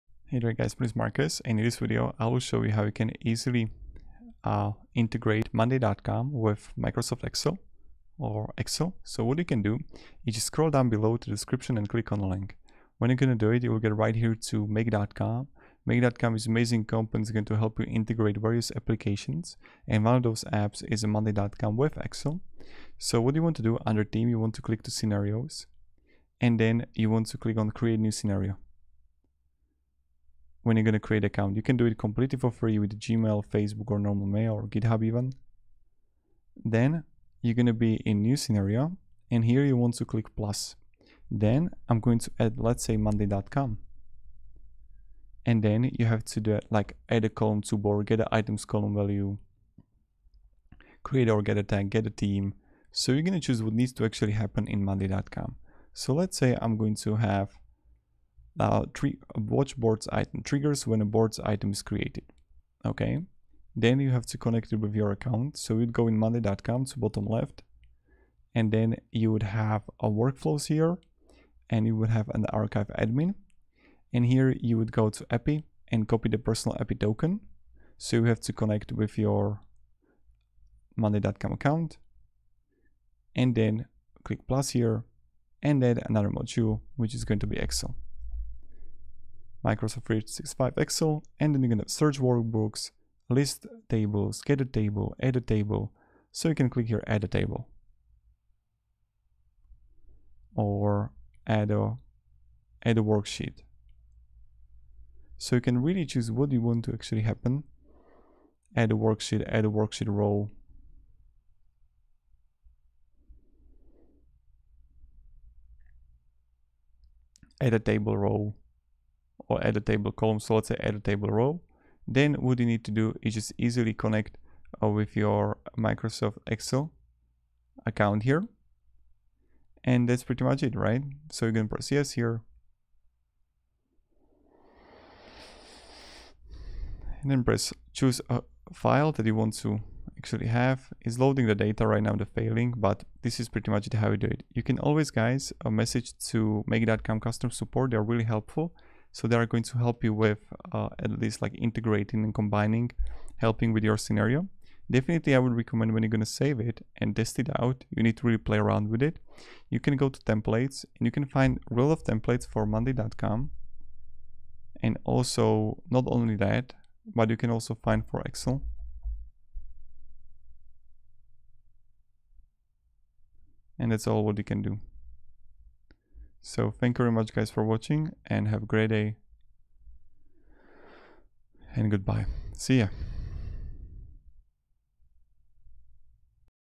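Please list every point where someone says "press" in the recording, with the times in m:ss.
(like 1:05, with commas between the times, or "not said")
2:11, 2:17.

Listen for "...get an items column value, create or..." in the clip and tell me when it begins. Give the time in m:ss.
0:48.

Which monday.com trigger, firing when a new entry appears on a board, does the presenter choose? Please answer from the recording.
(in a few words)
Watch boards item.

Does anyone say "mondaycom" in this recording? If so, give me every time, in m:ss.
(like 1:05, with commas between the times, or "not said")
0:05, 0:21, 0:42, 0:54, 1:06, 1:20, 2:42.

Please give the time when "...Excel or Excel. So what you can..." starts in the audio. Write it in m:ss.
0:07.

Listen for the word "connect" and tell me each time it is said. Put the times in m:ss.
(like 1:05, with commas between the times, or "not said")
1:04, 1:18, 2:03.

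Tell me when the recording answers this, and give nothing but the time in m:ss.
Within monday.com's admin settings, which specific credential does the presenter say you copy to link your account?
1:16.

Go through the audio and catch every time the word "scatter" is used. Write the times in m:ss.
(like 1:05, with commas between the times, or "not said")
1:34.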